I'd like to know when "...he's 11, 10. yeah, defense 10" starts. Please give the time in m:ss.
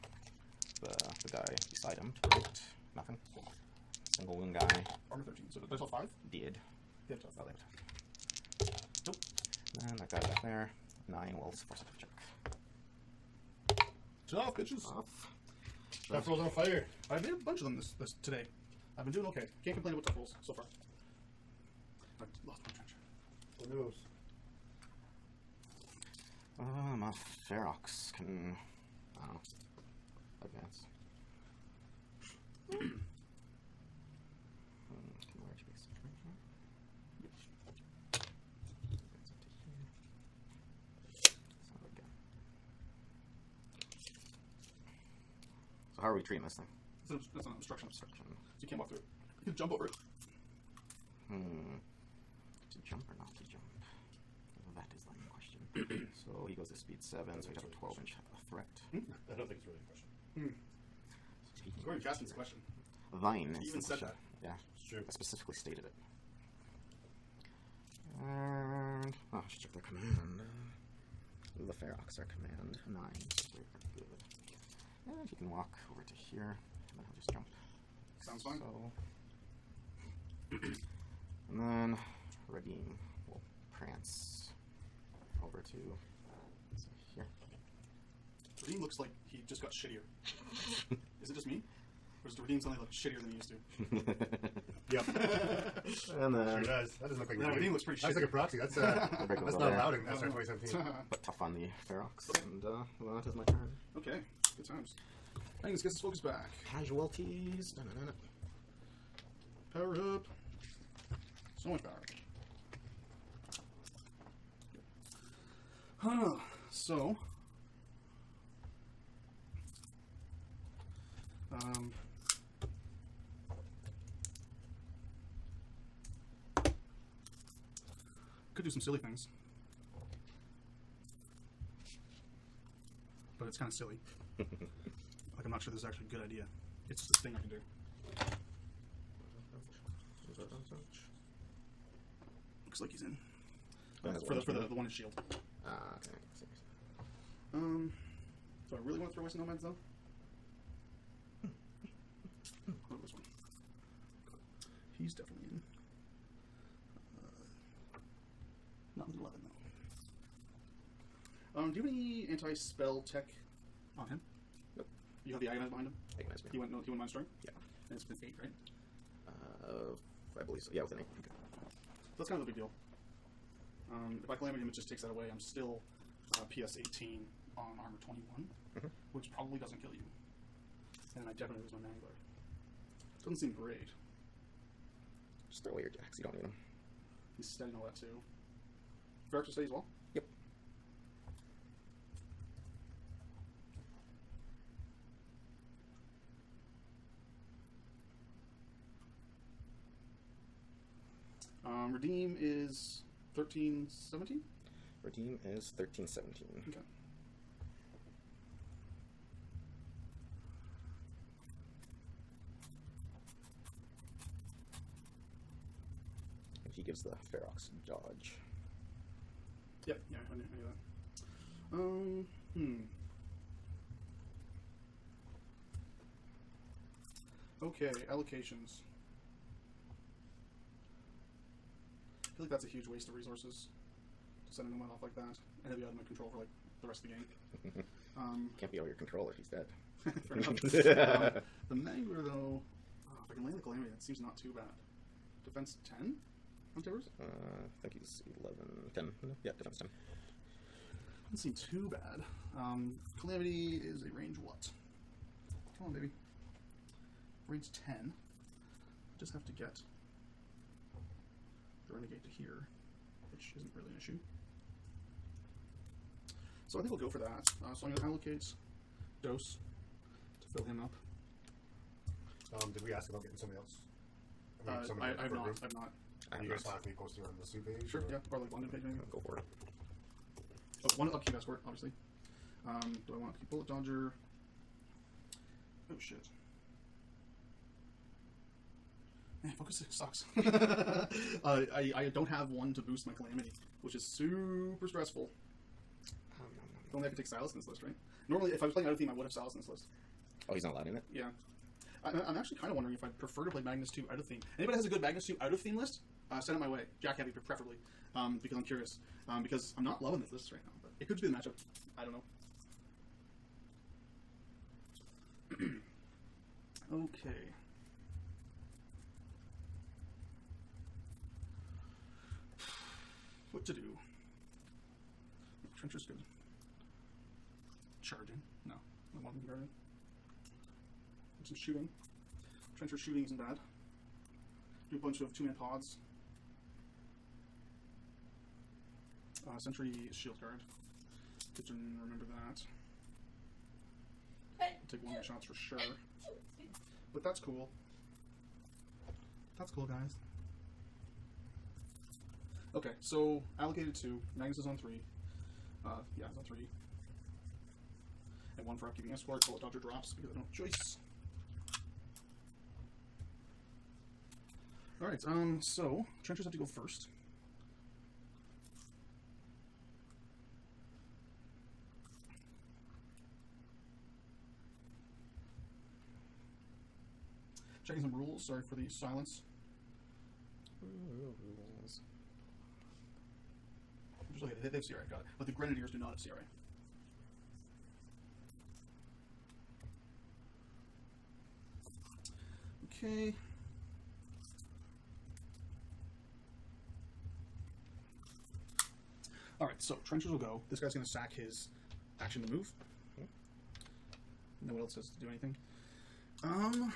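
4:08.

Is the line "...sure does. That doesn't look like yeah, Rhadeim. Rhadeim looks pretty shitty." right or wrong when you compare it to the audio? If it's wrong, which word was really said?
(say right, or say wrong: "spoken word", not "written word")
right.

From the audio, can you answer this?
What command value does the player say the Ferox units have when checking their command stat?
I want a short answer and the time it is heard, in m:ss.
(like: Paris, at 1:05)
9, at 1:12.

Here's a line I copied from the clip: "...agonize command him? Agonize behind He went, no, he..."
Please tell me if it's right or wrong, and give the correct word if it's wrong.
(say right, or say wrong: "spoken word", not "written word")
wrong: "behind", not "command".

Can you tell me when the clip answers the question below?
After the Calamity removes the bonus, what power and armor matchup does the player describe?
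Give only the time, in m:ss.
2:56.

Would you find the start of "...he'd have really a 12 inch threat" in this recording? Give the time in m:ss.
0:57.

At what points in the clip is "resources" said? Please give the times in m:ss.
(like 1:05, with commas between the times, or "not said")
3:53.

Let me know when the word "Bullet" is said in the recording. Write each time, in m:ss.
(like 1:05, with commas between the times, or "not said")
4:43, 5:59.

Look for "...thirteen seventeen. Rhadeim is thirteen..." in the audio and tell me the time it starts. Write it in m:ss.
3:23.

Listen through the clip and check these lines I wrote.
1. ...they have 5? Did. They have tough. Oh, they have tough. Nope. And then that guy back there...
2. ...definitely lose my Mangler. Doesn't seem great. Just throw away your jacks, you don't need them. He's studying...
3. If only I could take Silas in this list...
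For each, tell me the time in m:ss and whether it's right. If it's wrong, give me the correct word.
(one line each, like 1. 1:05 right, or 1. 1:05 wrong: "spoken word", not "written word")
1. 0:05 right
2. 3:01 right
3. 4:56 right.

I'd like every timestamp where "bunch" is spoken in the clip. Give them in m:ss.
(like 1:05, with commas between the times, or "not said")
0:17, 5:34.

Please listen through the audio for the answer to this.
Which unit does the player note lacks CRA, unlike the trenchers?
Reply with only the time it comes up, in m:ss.
6:25.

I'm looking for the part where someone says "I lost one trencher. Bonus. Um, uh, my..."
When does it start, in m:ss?
0:22.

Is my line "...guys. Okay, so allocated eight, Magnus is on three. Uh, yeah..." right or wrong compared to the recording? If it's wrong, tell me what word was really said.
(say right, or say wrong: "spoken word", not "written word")
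wrong: "two", not "eight".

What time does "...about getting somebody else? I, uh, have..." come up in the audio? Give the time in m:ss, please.
4:33.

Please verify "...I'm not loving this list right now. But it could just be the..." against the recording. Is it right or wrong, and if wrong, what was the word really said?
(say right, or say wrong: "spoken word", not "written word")
right.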